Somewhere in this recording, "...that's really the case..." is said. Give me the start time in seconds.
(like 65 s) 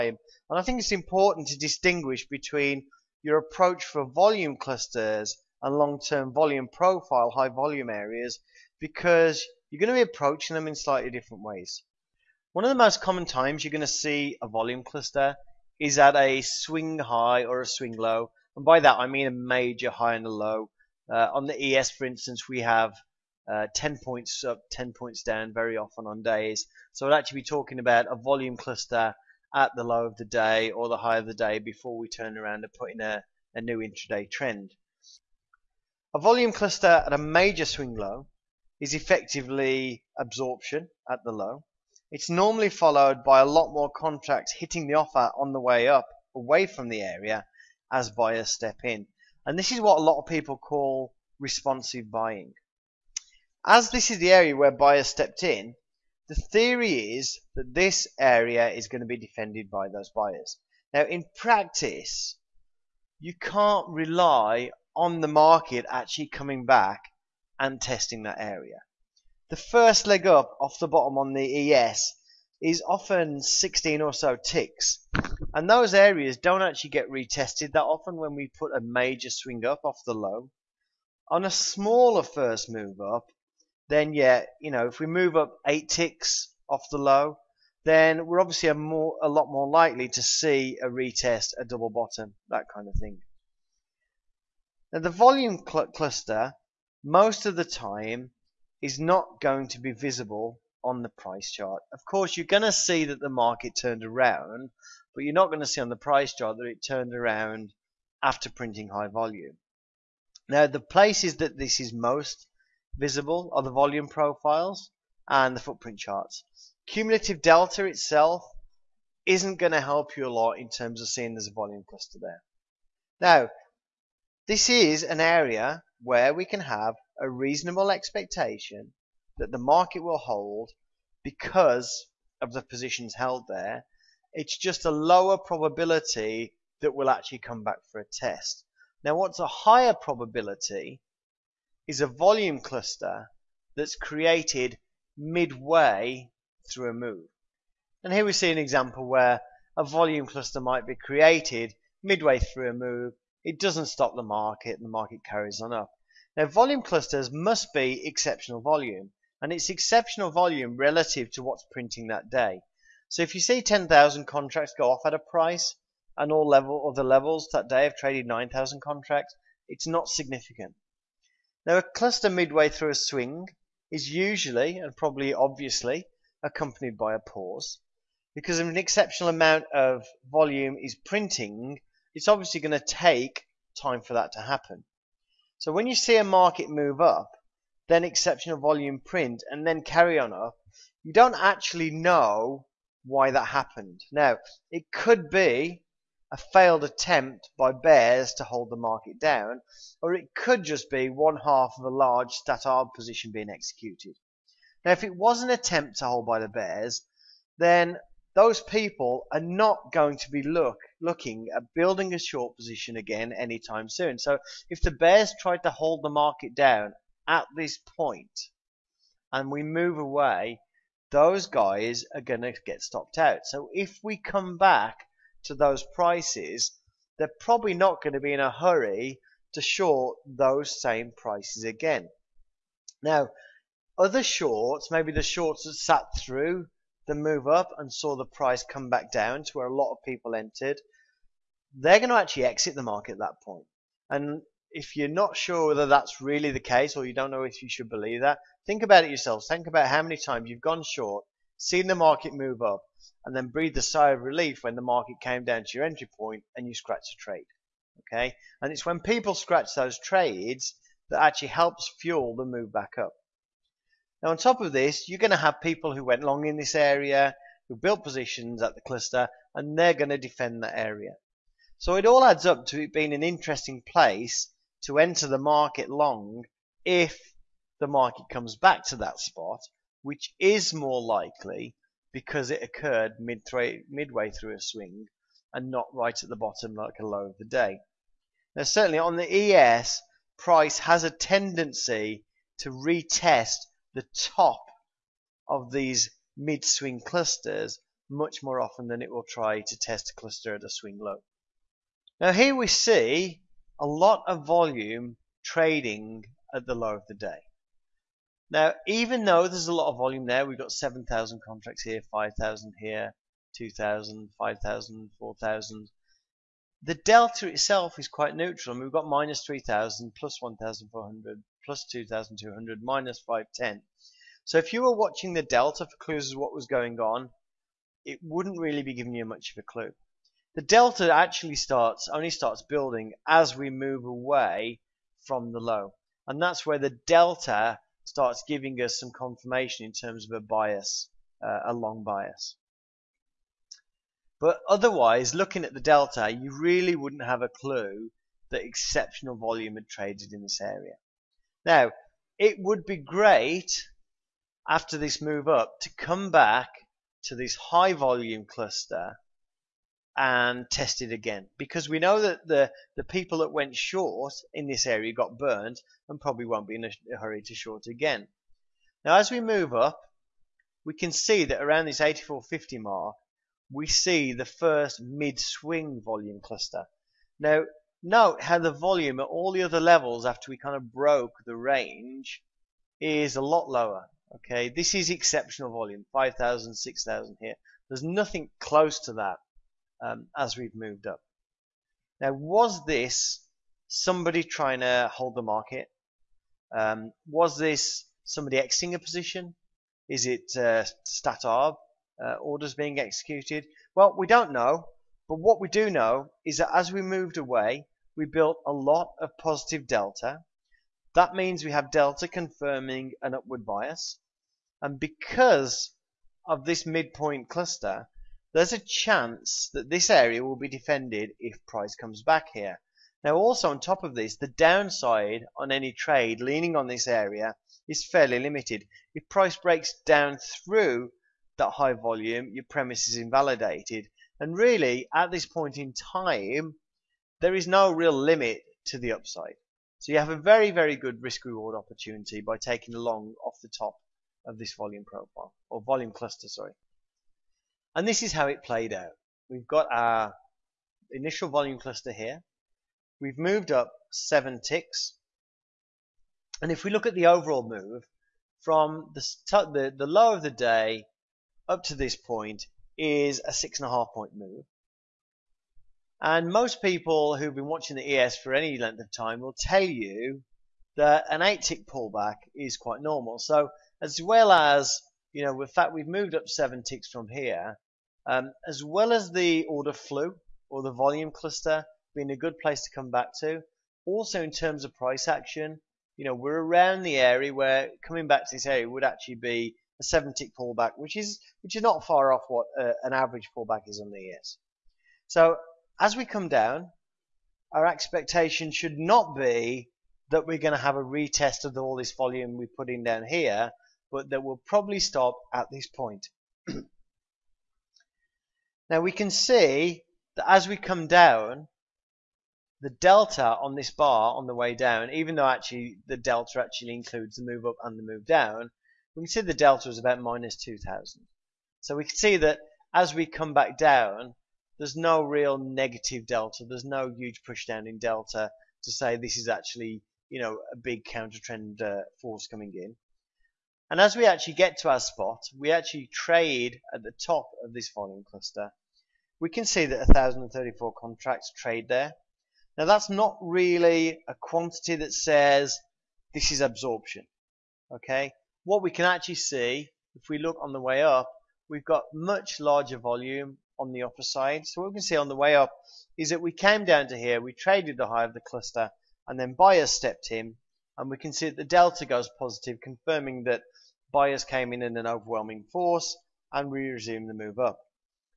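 245 s.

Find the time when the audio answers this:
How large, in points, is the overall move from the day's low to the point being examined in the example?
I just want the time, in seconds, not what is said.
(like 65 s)
463 s.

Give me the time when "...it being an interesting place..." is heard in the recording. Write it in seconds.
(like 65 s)
272 s.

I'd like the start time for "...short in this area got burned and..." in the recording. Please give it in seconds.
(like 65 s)
363 s.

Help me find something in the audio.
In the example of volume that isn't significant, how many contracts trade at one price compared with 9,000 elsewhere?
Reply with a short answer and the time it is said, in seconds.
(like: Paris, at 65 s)
10,000, at 163 s.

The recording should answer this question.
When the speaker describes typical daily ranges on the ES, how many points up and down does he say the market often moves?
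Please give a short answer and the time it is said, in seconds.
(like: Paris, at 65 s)
10 points, at 23 s.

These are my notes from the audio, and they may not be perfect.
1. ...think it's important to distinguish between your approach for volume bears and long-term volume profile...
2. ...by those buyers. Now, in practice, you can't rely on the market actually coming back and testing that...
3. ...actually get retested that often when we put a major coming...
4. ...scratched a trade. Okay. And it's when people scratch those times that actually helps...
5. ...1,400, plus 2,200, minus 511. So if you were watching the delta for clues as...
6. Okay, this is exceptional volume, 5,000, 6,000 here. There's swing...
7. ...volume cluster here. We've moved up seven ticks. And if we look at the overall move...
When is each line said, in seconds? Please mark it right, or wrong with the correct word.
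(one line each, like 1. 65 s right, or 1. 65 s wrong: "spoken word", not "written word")
1. 0 s wrong: "clusters", not "bears"
2. 59 s right
3. 76 s wrong: "swing", not "coming"
4. 256 s wrong: "trades", not "times"
5. 320 s wrong: "510", not "511"
6. 384 s wrong: "nothing", not "swing"
7. 451 s right.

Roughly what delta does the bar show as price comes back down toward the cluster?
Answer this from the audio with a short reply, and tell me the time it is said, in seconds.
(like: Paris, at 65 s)
minus 2,000, at 520 s.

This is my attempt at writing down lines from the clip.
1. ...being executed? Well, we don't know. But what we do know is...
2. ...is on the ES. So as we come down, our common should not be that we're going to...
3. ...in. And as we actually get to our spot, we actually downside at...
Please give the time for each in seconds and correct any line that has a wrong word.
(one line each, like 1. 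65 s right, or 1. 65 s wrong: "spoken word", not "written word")
1. 402 s right
2. 493 s wrong: "expectation", not "common"
3. 532 s wrong: "trade", not "downside".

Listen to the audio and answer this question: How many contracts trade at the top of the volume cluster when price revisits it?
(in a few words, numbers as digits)
1,034.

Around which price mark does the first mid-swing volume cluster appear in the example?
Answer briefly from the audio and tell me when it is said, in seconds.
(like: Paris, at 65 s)
8450, at 372 s.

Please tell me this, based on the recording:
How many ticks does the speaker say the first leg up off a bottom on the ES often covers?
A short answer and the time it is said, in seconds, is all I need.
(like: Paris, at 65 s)
16 ticks, at 73 s.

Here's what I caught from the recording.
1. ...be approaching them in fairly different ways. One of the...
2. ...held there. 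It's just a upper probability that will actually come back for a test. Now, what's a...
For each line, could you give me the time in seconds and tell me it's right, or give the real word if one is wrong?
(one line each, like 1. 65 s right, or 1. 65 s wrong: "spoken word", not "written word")
1. 10 s wrong: "slightly", not "fairly"
2. 133 s wrong: "lower", not "upper".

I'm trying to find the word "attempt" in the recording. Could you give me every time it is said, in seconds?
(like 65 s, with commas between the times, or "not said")
196 s, 205 s.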